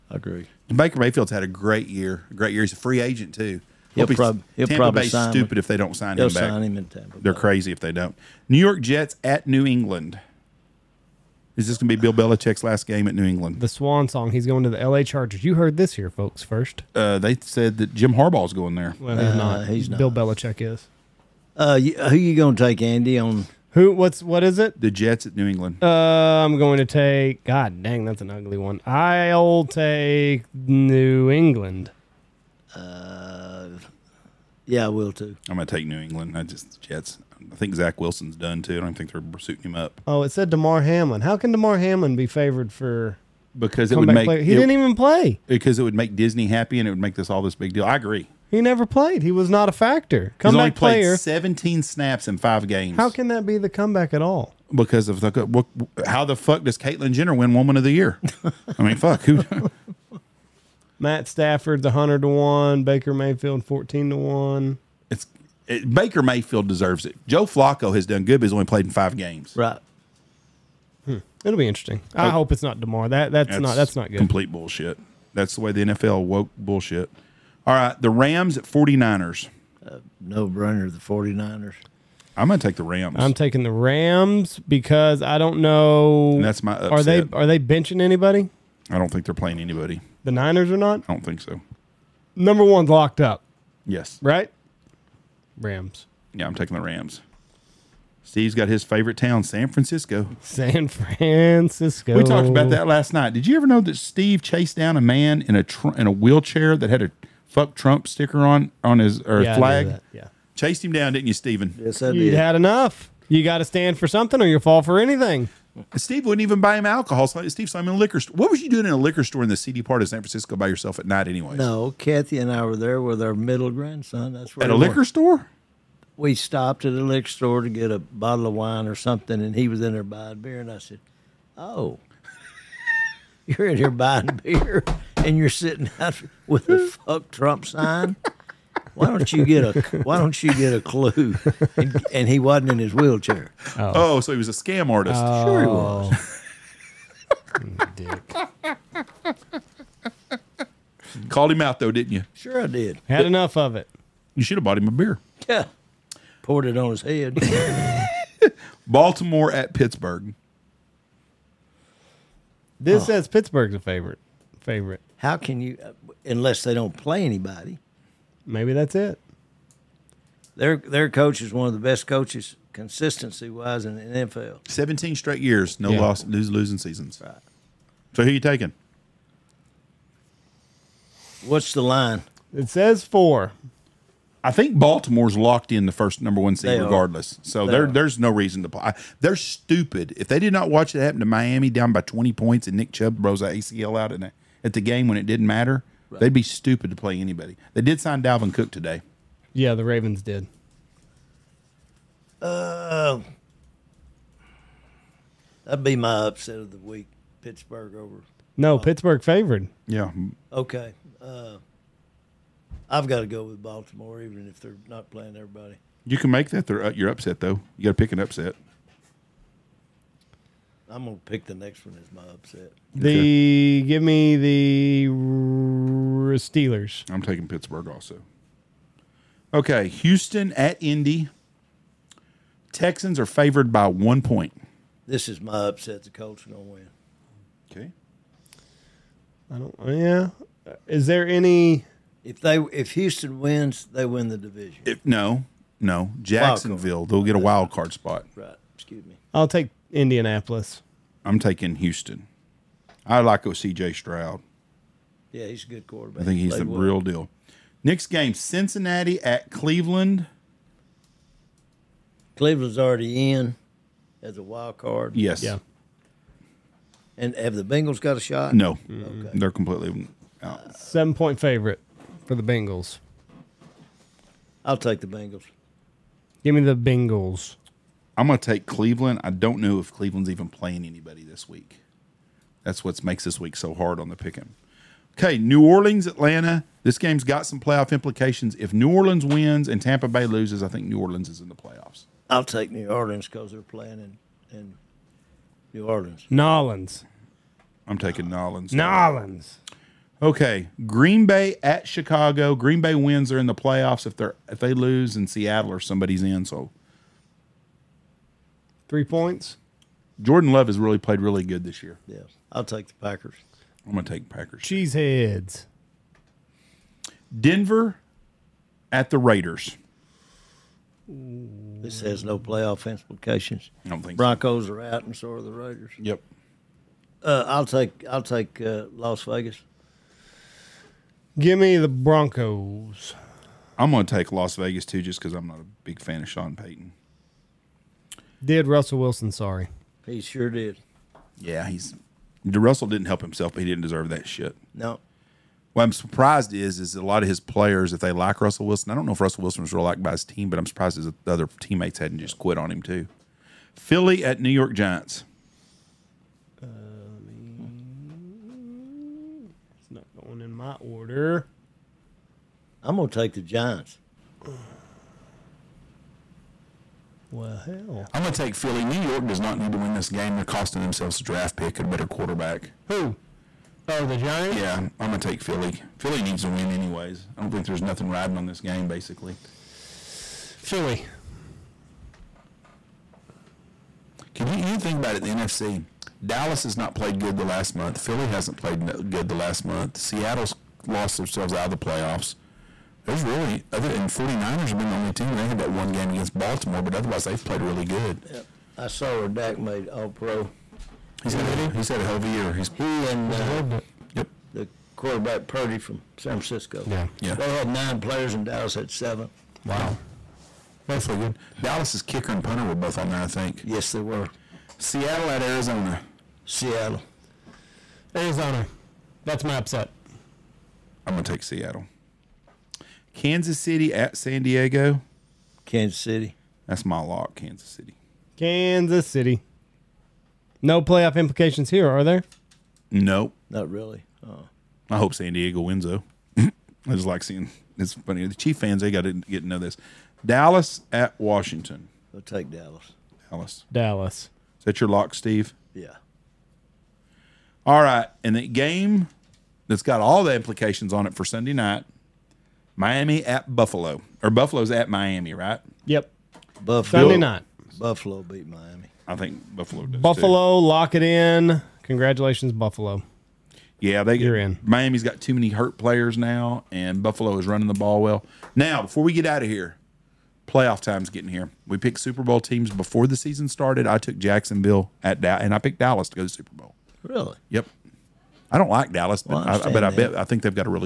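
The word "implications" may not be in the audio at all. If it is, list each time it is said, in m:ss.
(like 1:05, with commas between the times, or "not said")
4:47, 5:22, 7:11, 7:30.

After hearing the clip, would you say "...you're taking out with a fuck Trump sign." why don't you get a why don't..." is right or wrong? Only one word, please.
wrong.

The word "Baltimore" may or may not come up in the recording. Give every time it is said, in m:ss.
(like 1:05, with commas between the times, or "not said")
2:38, 3:04, 3:33, 6:36.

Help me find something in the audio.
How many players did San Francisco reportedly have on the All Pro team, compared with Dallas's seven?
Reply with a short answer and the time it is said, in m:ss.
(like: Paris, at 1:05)
9, at 6:47.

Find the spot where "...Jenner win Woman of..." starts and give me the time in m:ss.
0:57.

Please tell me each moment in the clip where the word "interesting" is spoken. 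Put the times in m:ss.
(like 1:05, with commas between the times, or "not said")
1:11.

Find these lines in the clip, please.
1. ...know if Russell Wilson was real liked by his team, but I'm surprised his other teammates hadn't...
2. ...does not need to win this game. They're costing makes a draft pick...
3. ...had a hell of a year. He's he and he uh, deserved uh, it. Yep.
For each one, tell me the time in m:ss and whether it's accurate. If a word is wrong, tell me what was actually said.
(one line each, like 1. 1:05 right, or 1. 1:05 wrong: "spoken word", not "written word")
1. 5:49 right
2. 6:09 wrong: "themselves", not "makes"
3. 6:41 right.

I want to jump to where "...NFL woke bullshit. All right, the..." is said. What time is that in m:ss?
1:15.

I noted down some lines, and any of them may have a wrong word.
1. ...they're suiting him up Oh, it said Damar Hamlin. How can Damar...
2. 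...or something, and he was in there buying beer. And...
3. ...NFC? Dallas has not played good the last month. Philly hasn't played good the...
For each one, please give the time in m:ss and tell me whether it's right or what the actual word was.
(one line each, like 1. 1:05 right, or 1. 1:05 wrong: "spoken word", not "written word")
1. 0:39 right
2. 2:08 right
3. 6:25 right.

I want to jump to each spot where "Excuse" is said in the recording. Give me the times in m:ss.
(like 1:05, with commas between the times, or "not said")
4:08.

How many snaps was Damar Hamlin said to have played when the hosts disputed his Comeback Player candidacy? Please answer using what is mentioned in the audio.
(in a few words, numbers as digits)
17.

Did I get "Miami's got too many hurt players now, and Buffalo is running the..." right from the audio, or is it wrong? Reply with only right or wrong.
right.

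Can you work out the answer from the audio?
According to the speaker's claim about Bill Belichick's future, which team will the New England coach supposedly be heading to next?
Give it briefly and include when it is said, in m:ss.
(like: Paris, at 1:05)
L.A. Chargers, at 0:14.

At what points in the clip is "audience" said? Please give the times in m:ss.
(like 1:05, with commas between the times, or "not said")
not said.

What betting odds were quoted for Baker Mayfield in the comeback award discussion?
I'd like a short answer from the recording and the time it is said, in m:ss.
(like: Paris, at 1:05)
14 to 1, at 1:03.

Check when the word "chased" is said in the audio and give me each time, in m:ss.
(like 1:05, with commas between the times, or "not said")
1:44, 1:50.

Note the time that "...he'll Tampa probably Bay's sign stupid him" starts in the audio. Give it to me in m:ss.
0:04.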